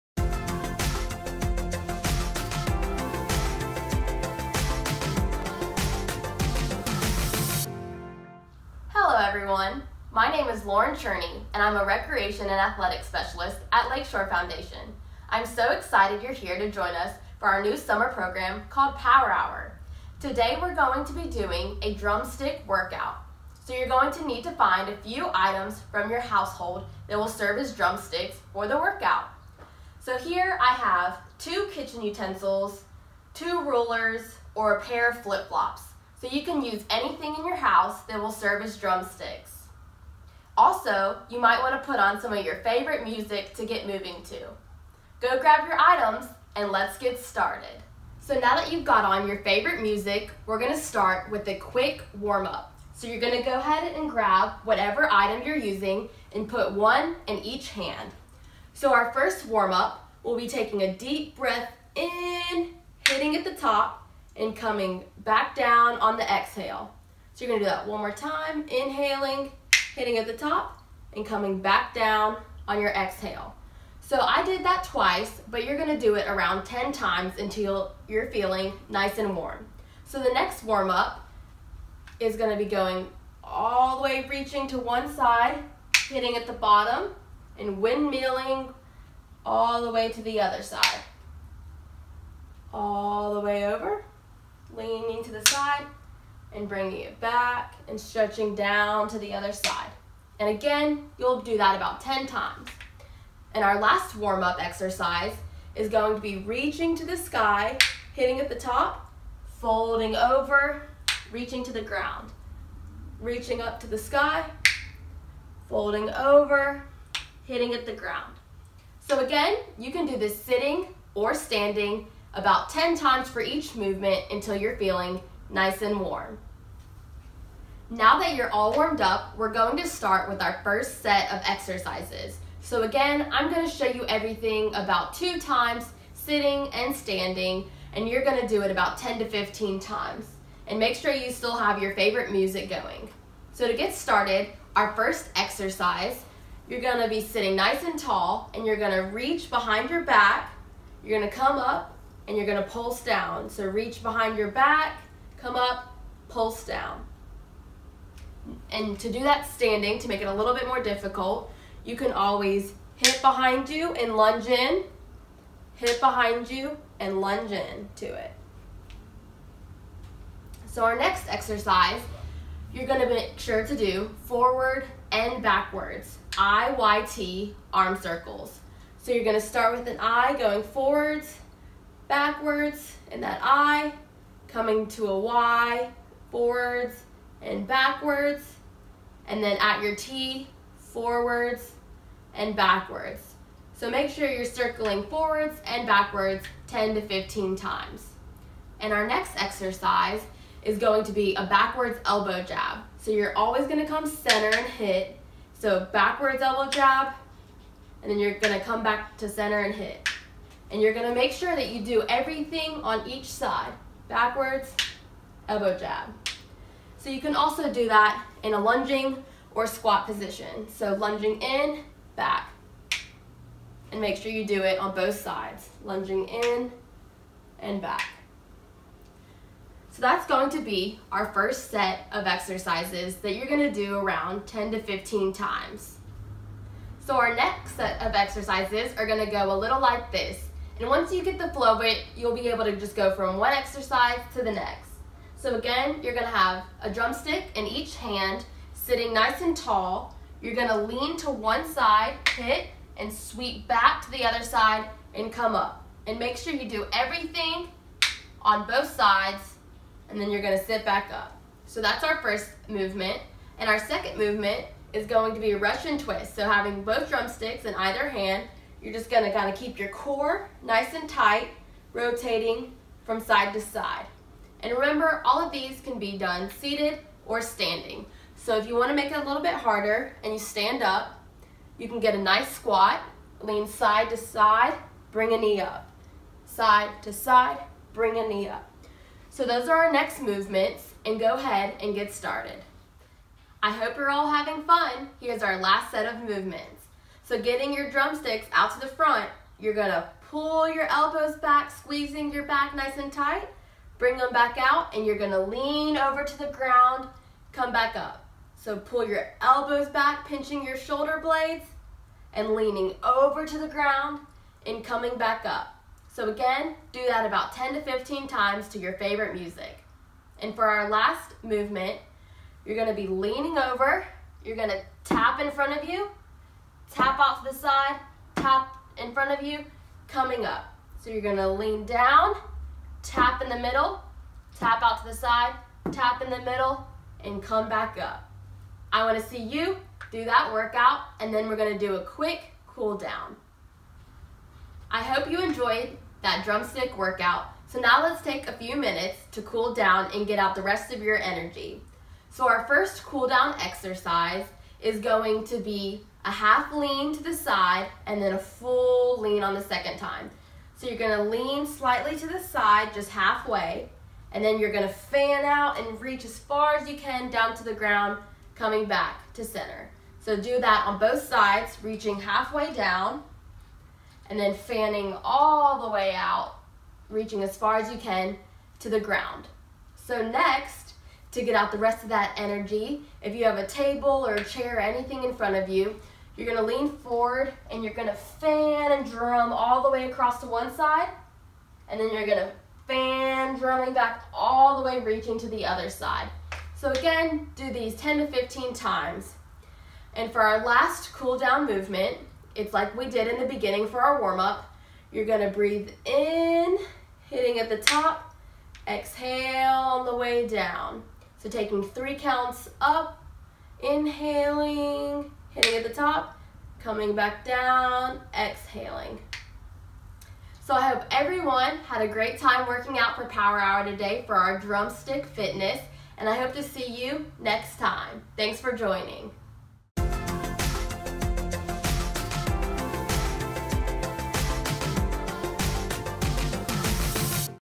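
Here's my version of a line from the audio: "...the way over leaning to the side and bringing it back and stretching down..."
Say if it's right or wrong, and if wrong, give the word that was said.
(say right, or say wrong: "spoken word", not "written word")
right.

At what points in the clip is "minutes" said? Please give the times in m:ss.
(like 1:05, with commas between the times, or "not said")
5:48.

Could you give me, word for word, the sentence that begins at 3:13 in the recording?
So make sure you're circling forwards and backwards 10 to 15 times.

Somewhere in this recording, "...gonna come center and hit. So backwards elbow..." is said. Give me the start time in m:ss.
3:23.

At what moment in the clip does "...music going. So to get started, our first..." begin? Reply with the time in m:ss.
2:22.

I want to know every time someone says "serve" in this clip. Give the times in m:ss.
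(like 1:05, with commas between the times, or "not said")
0:27, 0:38.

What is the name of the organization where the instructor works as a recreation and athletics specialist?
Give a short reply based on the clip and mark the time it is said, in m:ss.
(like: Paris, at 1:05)
Lakeshore Foundation, at 0:13.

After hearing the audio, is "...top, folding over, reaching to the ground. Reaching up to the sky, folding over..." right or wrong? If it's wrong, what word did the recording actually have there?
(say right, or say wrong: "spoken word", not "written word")
right.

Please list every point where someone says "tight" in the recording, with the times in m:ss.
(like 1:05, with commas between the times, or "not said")
4:31, 5:03.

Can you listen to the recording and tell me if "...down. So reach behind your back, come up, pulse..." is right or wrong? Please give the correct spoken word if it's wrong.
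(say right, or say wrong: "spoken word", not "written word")
right.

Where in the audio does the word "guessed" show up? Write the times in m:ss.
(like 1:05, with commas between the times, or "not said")
not said.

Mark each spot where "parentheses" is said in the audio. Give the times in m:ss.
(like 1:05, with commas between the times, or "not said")
not said.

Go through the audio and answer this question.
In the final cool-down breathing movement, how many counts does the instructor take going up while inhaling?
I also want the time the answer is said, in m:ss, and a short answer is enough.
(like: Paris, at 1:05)
3, at 6:51.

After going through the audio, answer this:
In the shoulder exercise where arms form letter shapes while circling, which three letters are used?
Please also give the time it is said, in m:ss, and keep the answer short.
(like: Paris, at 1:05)
IYT, at 2:56.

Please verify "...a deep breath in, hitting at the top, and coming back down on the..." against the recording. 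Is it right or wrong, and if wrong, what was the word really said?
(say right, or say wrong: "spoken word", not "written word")
right.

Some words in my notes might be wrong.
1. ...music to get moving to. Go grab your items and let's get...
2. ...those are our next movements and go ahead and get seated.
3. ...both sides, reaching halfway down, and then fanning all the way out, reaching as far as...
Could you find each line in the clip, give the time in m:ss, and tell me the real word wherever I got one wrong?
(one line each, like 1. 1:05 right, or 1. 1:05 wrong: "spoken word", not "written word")
1. 0:43 right
2. 4:49 wrong: "started", not "seated"
3. 6:10 right.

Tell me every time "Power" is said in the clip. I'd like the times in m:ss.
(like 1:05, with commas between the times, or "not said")
0:18, 7:03.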